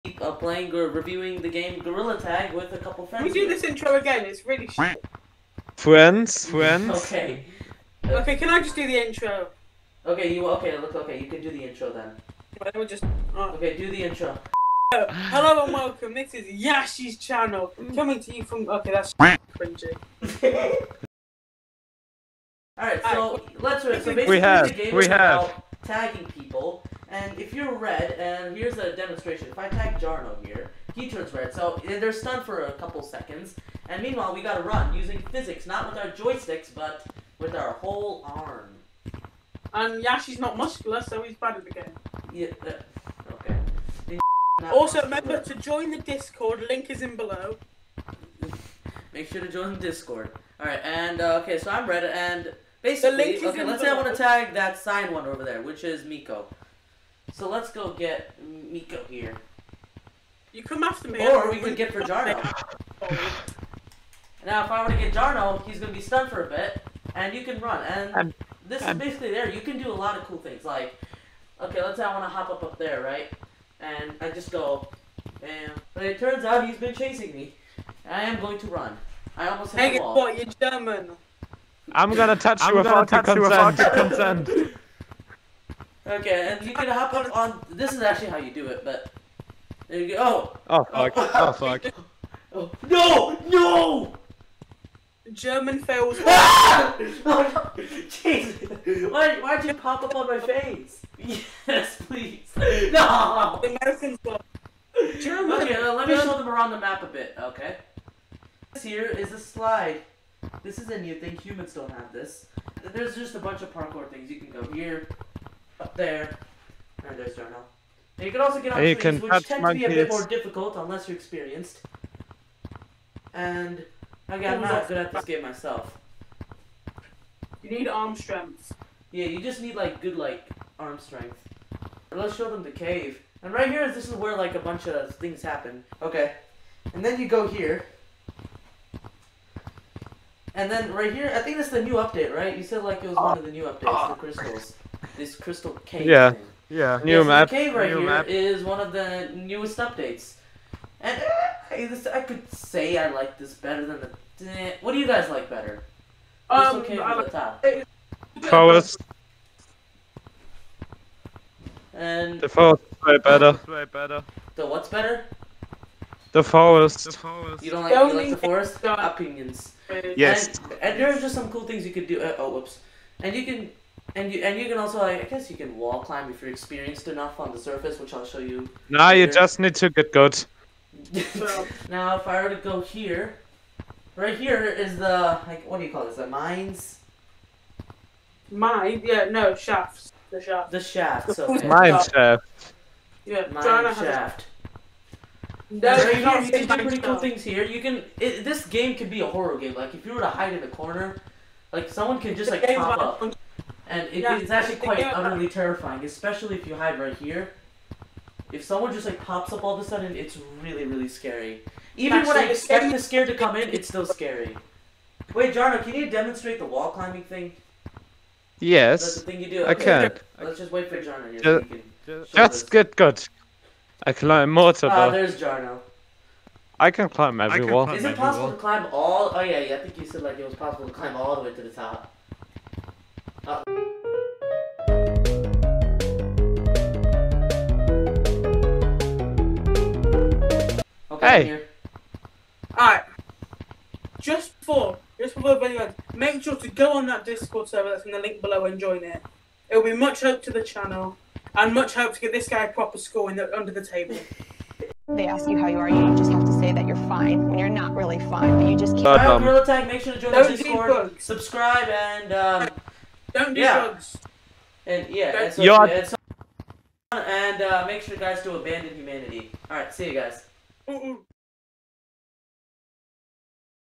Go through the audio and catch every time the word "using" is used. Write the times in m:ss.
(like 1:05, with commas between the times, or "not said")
0:34.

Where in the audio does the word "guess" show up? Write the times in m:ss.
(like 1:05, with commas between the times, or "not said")
2:55.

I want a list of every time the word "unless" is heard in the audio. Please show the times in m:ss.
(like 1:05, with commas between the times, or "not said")
2:00.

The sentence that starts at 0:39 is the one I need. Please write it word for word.
And Yashi's not muscular, so he's bad at the game.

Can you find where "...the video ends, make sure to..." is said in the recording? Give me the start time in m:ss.
4:05.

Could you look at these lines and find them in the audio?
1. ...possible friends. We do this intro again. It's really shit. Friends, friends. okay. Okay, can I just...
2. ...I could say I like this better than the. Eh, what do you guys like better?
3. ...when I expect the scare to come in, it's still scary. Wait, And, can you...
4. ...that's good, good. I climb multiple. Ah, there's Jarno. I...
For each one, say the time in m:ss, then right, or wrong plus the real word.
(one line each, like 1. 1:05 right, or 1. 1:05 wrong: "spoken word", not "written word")
1. 0:02 wrong: "couple", not "possible"
2. 2:32 right
3. 3:32 wrong: "Jarno", not "And"
4. 3:42 right.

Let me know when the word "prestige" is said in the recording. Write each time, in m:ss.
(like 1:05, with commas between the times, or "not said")
not said.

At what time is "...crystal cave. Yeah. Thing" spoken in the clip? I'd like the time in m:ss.
2:25.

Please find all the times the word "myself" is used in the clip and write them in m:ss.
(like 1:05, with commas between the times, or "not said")
2:05.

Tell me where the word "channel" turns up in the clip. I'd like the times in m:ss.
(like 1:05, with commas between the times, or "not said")
0:17, 4:10.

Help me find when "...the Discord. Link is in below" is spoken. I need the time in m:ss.
0:45.